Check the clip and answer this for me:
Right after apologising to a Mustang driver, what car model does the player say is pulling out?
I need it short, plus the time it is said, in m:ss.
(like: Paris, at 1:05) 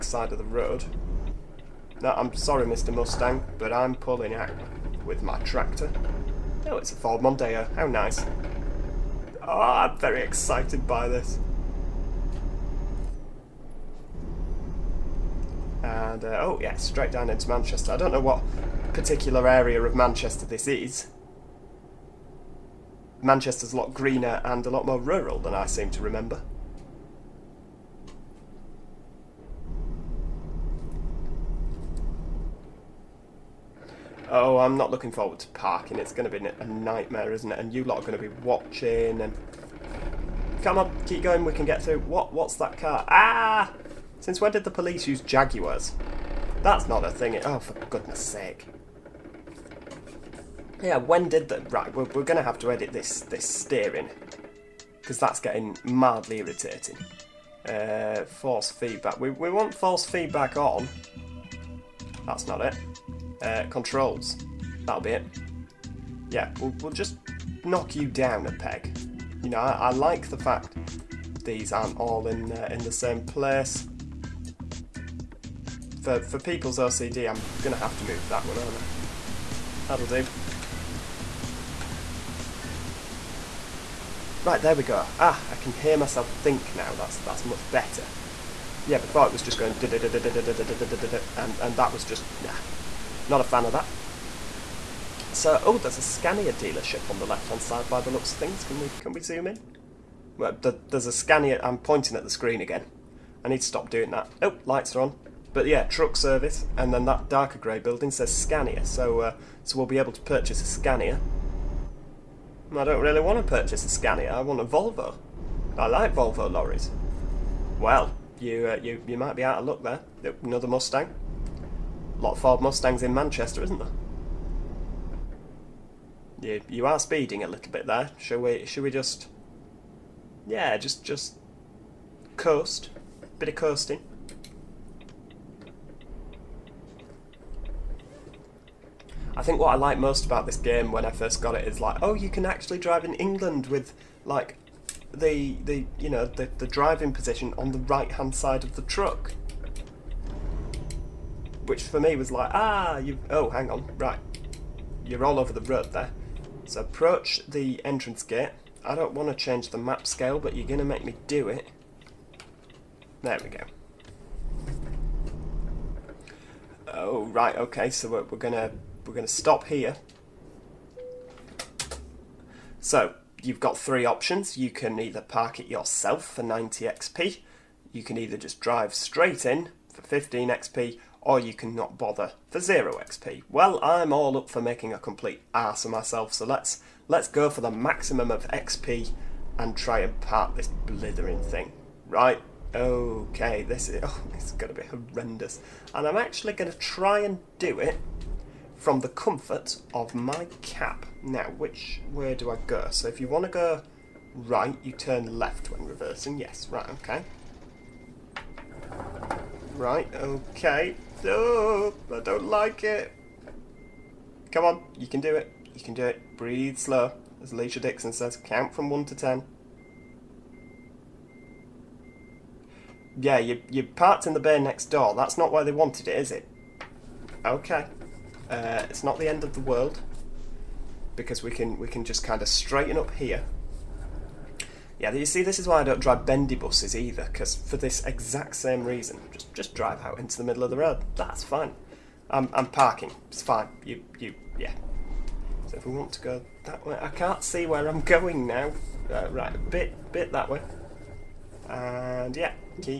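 Ford Mondeo, at 0:06.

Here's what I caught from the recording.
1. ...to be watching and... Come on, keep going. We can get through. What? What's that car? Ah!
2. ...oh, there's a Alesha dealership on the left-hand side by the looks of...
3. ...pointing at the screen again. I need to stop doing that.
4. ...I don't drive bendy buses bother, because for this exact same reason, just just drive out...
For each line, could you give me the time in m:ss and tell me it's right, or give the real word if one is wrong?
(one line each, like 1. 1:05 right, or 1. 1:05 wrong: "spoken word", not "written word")
1. 0:38 right
2. 1:35 wrong: "Scania", not "Alesha"
3. 1:41 right
4. 3:55 wrong: "either", not "bother".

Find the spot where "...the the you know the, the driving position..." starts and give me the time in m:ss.
2:25.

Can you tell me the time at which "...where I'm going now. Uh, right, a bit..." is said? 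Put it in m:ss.
4:07.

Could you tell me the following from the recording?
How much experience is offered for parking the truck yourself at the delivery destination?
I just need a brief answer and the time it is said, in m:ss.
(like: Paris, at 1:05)
90 XP, at 2:56.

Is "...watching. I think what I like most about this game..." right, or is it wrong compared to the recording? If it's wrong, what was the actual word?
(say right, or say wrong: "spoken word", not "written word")
wrong: "coasting", not "watching".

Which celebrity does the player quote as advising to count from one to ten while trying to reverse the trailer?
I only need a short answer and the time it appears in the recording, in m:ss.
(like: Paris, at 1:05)
Alesha Dixon, at 3:37.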